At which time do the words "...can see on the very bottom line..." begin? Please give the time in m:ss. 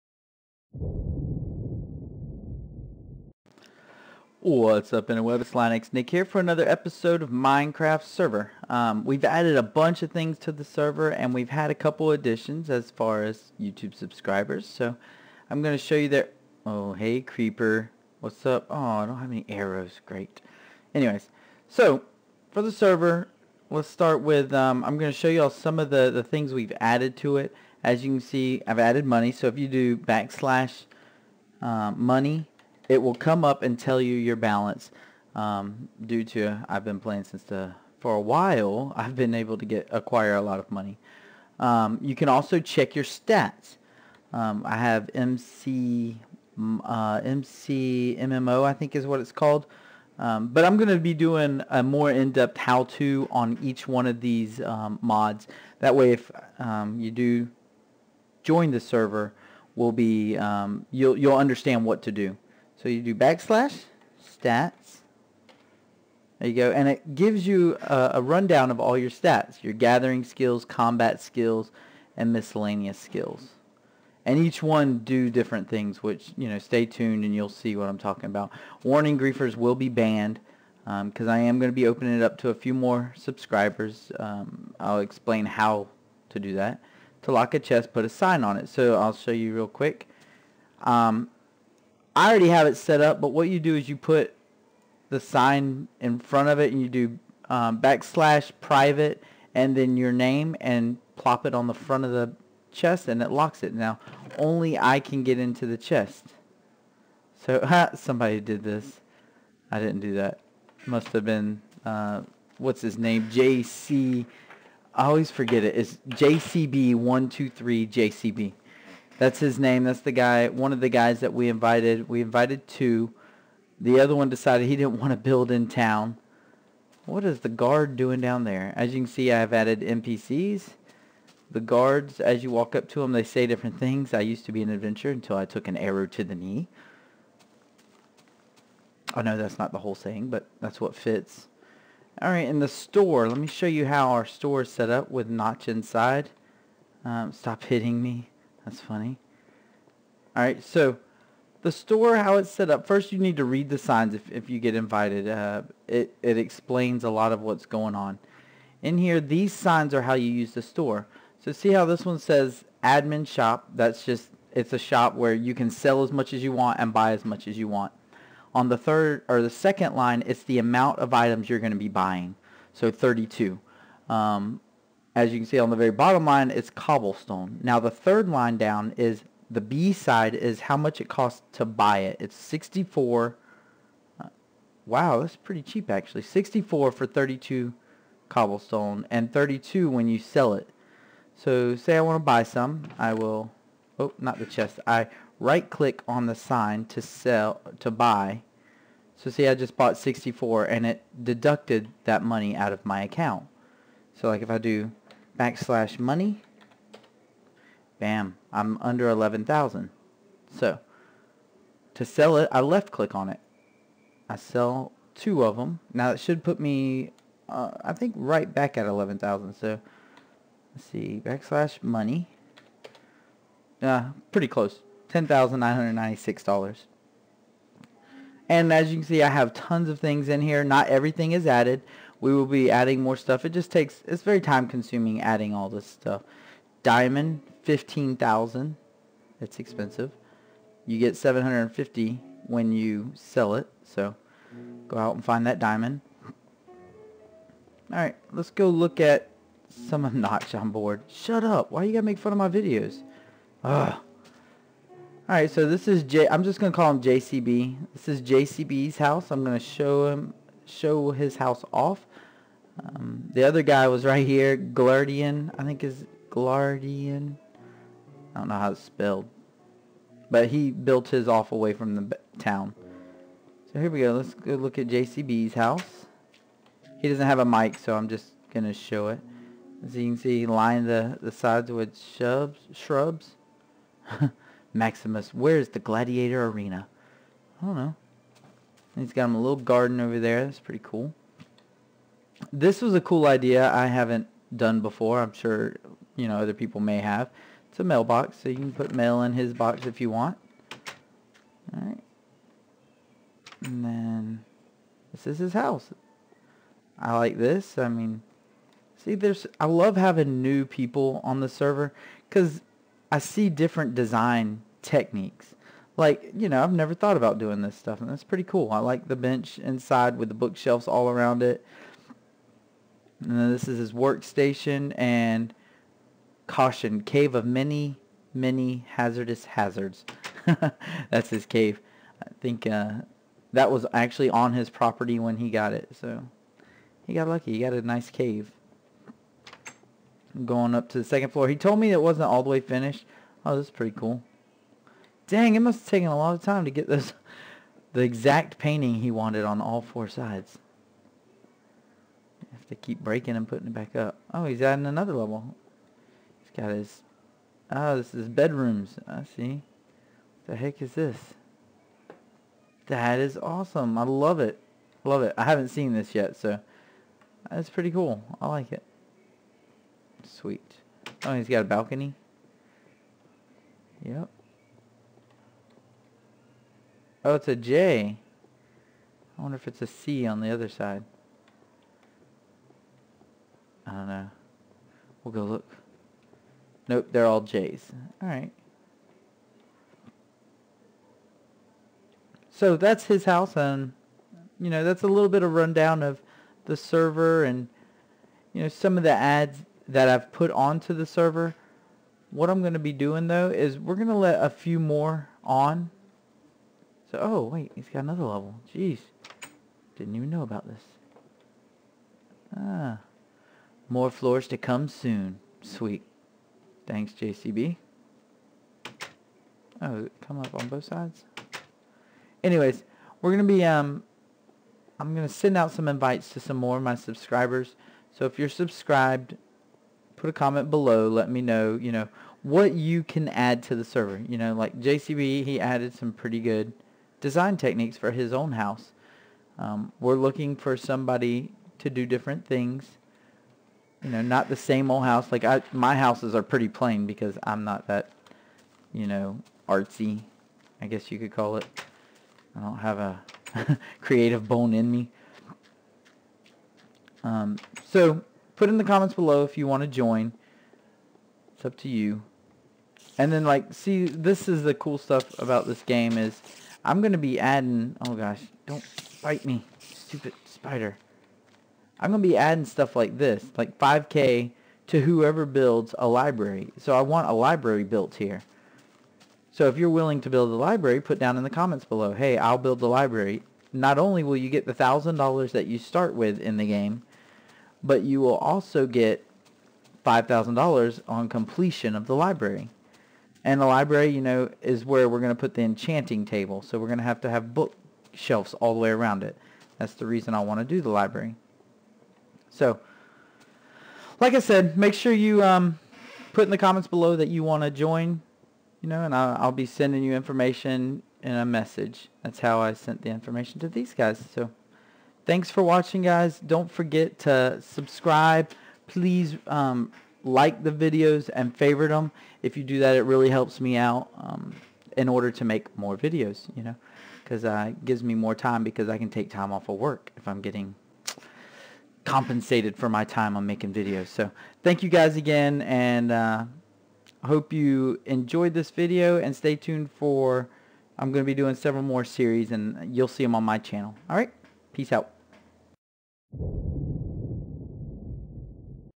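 2:55.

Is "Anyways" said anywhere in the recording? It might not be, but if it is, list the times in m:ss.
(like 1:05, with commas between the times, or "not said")
0:20, 7:02.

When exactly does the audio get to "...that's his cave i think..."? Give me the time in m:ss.
5:31.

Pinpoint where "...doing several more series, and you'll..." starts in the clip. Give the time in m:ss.
9:01.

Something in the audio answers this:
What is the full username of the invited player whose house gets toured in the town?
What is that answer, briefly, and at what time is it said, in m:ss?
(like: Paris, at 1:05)
JCB123JCB, at 1:56.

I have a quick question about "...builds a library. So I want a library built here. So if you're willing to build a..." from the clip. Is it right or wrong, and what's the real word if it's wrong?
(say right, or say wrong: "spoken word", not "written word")
right.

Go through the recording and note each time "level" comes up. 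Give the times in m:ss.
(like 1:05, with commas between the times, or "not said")
5:55, 6:48.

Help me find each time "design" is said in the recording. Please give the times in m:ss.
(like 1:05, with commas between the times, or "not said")
5:13, 7:17.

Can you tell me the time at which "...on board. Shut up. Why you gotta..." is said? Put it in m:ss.
4:10.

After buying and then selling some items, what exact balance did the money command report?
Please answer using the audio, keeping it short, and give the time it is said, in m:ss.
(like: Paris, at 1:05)
$10,996, at 3:45.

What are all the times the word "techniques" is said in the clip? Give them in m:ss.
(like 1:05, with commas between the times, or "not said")
5:14, 7:17.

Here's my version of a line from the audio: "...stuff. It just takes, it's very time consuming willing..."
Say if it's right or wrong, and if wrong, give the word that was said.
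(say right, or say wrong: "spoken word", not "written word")
wrong: "adding", not "willing".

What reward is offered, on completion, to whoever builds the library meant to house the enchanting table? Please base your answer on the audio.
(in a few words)
$5,000.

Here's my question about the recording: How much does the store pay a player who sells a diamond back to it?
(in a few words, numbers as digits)
750.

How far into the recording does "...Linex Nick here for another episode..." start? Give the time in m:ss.
0:05.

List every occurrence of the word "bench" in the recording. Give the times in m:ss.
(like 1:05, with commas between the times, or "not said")
5:19.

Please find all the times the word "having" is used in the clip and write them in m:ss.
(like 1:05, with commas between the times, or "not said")
5:09.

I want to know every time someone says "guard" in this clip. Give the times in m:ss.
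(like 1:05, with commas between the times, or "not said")
2:07, 2:11.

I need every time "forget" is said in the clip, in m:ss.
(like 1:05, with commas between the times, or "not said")
1:55, 8:36.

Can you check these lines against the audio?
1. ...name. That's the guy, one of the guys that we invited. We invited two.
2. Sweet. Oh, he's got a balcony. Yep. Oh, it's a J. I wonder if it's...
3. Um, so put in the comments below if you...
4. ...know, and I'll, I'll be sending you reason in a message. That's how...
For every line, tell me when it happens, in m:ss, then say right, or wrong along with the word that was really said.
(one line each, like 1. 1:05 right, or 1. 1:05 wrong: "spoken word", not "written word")
1. 1:59 right
2. 6:10 right
3. 7:37 right
4. 8:28 wrong: "information", not "reason".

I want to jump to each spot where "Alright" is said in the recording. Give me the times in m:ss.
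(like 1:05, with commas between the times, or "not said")
2:22, 4:07, 4:15, 5:01, 6:28.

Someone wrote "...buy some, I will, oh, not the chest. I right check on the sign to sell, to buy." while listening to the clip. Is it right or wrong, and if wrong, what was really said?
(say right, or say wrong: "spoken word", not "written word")
wrong: "click", not "check".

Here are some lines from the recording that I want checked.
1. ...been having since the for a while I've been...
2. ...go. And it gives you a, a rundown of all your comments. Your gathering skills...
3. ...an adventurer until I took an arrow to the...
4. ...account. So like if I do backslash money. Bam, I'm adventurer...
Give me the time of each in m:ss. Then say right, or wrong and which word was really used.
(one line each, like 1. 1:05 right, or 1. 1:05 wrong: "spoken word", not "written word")
1. 0:36 wrong: "playing", not "having"
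2. 1:06 wrong: "stats", not "comments"
3. 2:14 right
4. 3:23 wrong: "under", not "adventurer".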